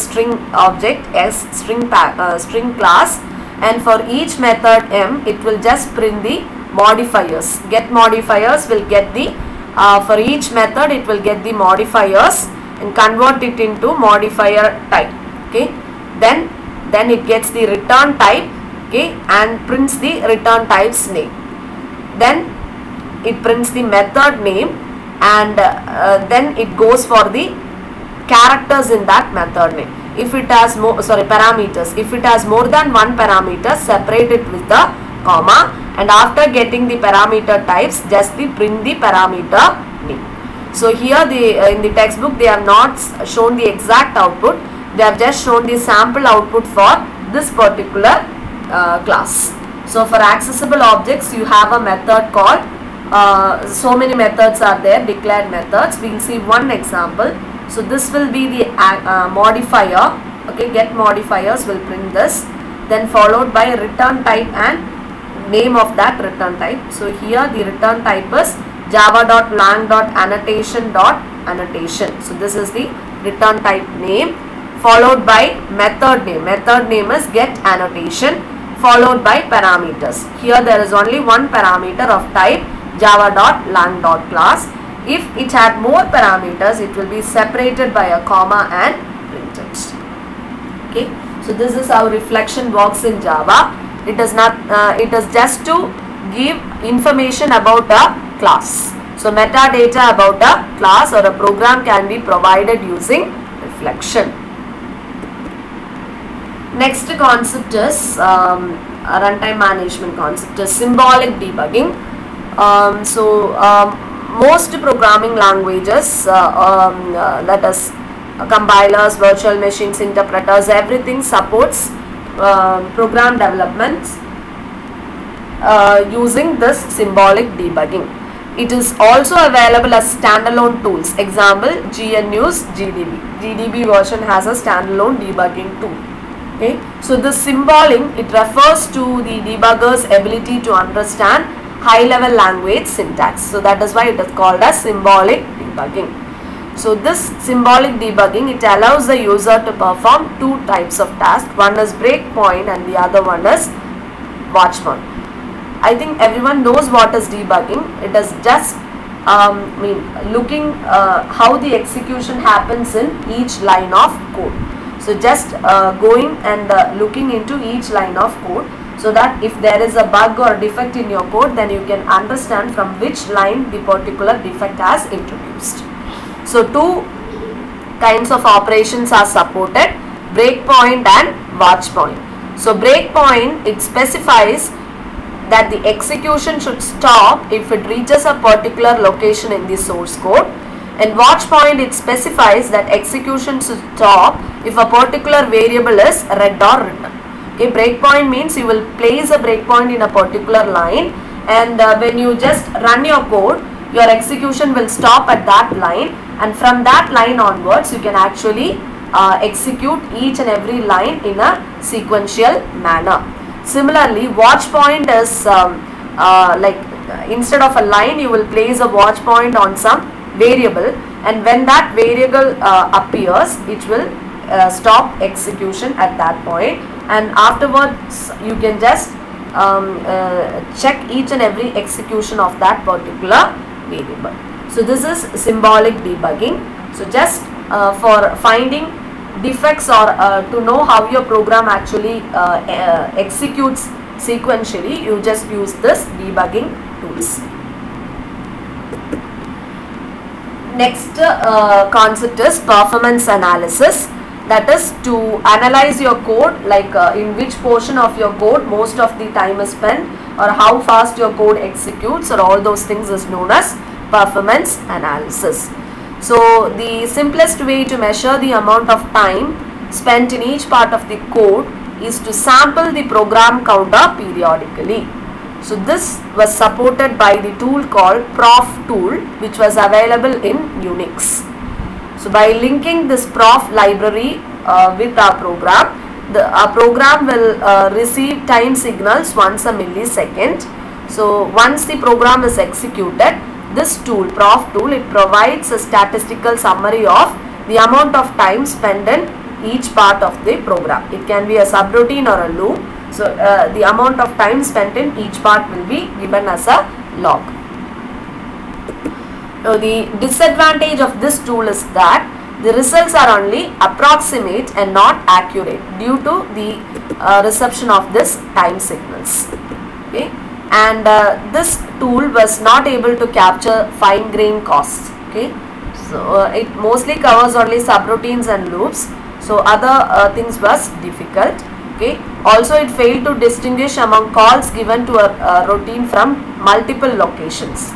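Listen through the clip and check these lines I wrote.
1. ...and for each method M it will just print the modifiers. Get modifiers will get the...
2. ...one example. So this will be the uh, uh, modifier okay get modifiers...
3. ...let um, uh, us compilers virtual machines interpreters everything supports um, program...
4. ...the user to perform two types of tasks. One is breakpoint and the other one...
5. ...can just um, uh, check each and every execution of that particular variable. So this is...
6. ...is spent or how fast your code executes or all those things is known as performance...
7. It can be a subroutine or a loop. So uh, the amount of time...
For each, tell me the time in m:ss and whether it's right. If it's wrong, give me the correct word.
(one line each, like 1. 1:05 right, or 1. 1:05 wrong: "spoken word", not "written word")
1. 0:03 right
2. 0:56 right
3. 1:57 right
4. 2:29 right
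5. 3:48 right
6. 4:19 right
7. 5:01 right.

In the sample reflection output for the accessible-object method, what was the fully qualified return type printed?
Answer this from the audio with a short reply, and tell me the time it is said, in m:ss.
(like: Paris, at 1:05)
java.lang.annotation.Annotation, at 1:08.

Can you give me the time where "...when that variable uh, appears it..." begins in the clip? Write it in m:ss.
3:41.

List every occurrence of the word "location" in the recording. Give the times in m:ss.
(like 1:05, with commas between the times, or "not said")
3:09, 5:37.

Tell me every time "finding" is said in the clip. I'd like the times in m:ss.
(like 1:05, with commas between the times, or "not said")
3:58.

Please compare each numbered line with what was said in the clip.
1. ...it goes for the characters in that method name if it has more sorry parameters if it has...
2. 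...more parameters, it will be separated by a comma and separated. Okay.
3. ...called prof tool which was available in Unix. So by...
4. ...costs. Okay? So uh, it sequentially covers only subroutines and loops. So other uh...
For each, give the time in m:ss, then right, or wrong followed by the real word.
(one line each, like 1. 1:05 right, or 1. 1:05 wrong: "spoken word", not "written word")
1. 0:26 right
2. 1:25 wrong: "printed", not "separated"
3. 4:37 right
4. 5:24 wrong: "mostly", not "sequentially".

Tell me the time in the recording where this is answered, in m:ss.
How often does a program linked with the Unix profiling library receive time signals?
4:49.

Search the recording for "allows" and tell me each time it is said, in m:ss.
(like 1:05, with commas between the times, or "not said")
2:28.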